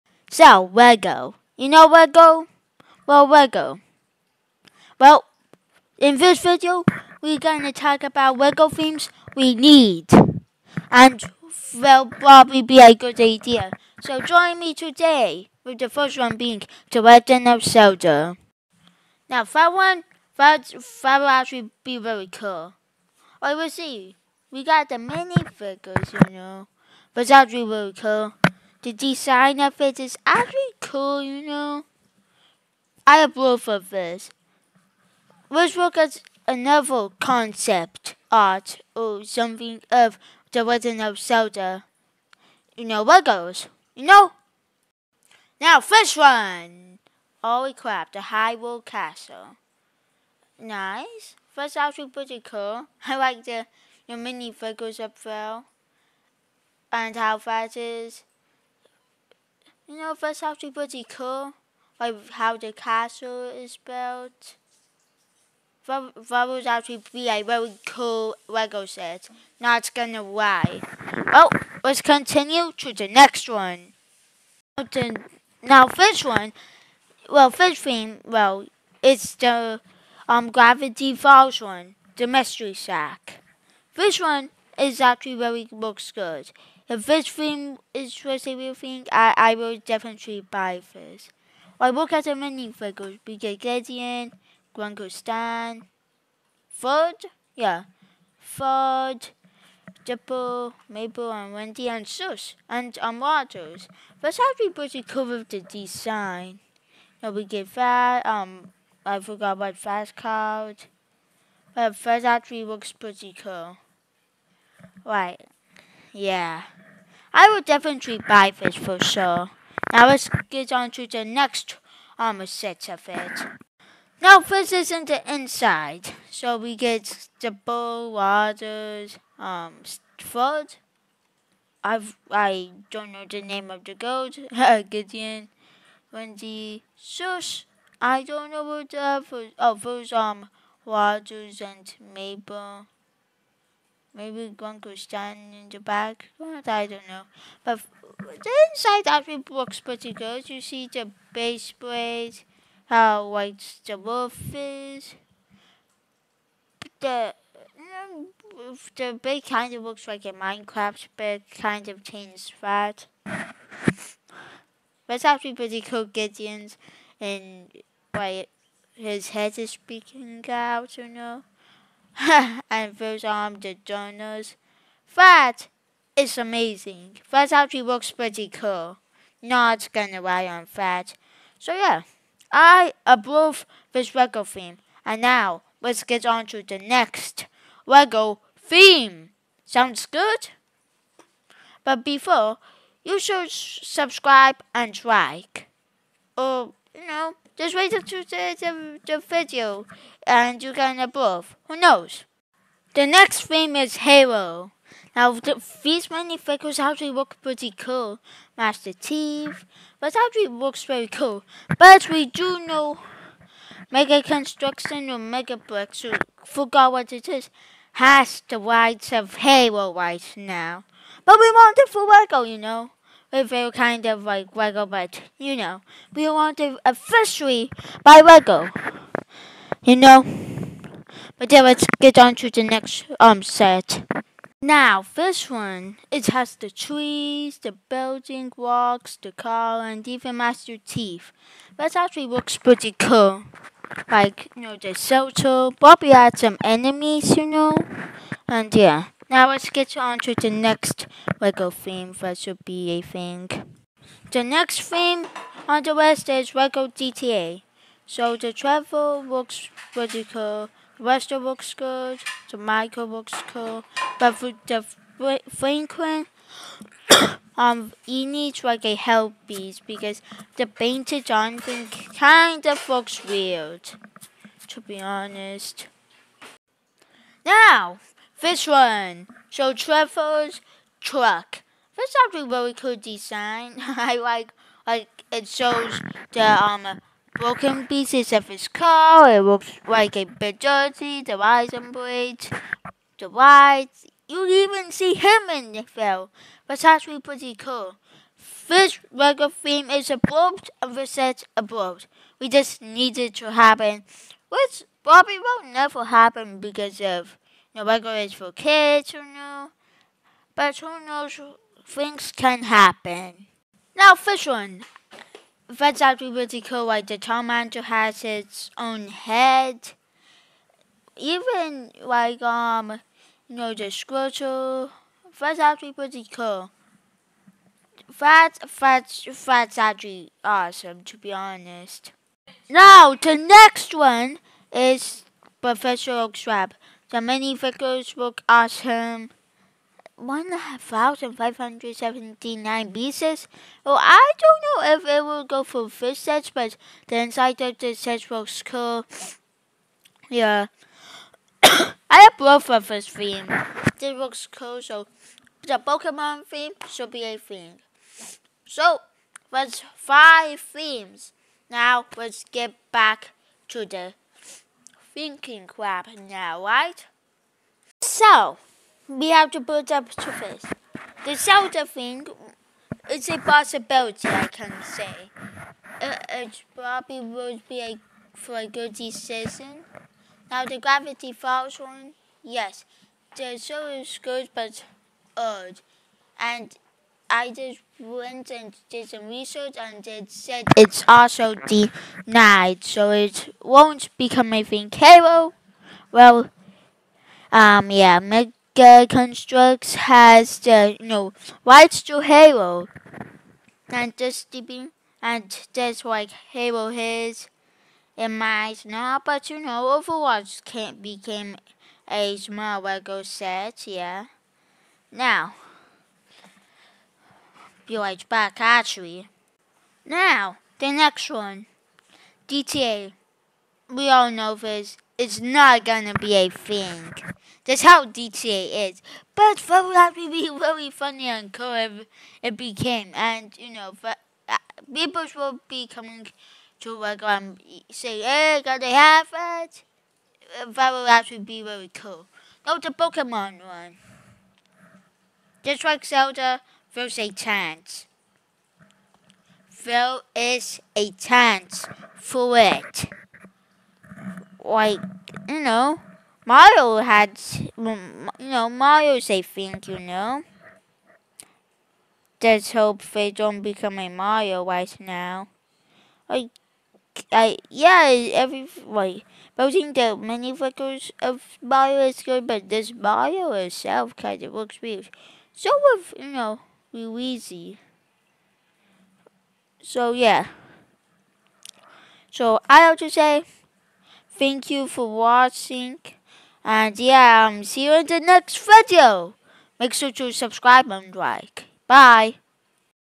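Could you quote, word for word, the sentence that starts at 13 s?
So join me today, with the first one being The Legend of Zelda.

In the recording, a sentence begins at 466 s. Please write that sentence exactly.
Like, I, yeah, every, like, think the many flickers of Mario is good, but this Mario itself kind of looks weird.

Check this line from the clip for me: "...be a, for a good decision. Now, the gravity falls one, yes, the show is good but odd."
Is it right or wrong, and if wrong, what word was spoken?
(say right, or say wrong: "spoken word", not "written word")
right.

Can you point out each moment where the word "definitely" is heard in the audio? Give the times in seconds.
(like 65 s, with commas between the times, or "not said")
89 s, 117 s.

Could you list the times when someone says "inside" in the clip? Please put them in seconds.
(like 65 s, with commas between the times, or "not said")
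125 s, 148 s, 347 s.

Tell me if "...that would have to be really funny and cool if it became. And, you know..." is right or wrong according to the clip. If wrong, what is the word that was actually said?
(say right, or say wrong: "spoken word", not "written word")
right.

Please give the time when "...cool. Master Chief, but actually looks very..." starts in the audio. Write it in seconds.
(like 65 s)
207 s.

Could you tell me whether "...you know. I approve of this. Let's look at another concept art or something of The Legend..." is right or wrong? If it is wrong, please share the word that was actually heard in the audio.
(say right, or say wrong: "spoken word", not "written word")
right.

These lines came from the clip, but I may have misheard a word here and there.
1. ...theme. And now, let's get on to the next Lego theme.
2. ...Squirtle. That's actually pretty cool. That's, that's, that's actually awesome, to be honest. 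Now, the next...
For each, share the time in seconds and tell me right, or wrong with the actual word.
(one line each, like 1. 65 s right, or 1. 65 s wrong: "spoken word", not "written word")
1. 184 s right
2. 323 s right.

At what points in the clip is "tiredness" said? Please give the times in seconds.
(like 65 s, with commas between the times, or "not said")
not said.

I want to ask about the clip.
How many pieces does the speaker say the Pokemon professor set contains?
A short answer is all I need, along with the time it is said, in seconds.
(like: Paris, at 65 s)
1579, at 340 s.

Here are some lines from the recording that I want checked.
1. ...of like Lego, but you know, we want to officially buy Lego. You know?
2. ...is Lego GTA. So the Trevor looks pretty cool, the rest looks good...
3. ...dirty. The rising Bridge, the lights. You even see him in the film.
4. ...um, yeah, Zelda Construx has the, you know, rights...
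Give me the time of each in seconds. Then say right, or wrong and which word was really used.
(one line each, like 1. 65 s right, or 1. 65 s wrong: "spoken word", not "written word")
1. 224 s right
2. 256 s right
3. 290 s right
4. 397 s wrong: "Mega", not "Zelda".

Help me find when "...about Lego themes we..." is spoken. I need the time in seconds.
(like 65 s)
8 s.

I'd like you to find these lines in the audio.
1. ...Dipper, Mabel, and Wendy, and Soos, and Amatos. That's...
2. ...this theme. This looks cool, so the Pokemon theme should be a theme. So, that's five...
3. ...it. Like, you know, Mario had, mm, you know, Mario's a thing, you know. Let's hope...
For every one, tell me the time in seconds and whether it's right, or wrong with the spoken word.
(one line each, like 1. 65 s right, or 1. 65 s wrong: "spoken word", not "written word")
1. 100 s right
2. 352 s right
3. 452 s right.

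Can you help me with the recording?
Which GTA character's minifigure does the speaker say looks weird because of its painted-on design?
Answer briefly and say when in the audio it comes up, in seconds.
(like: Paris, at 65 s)
Franklin, at 265 s.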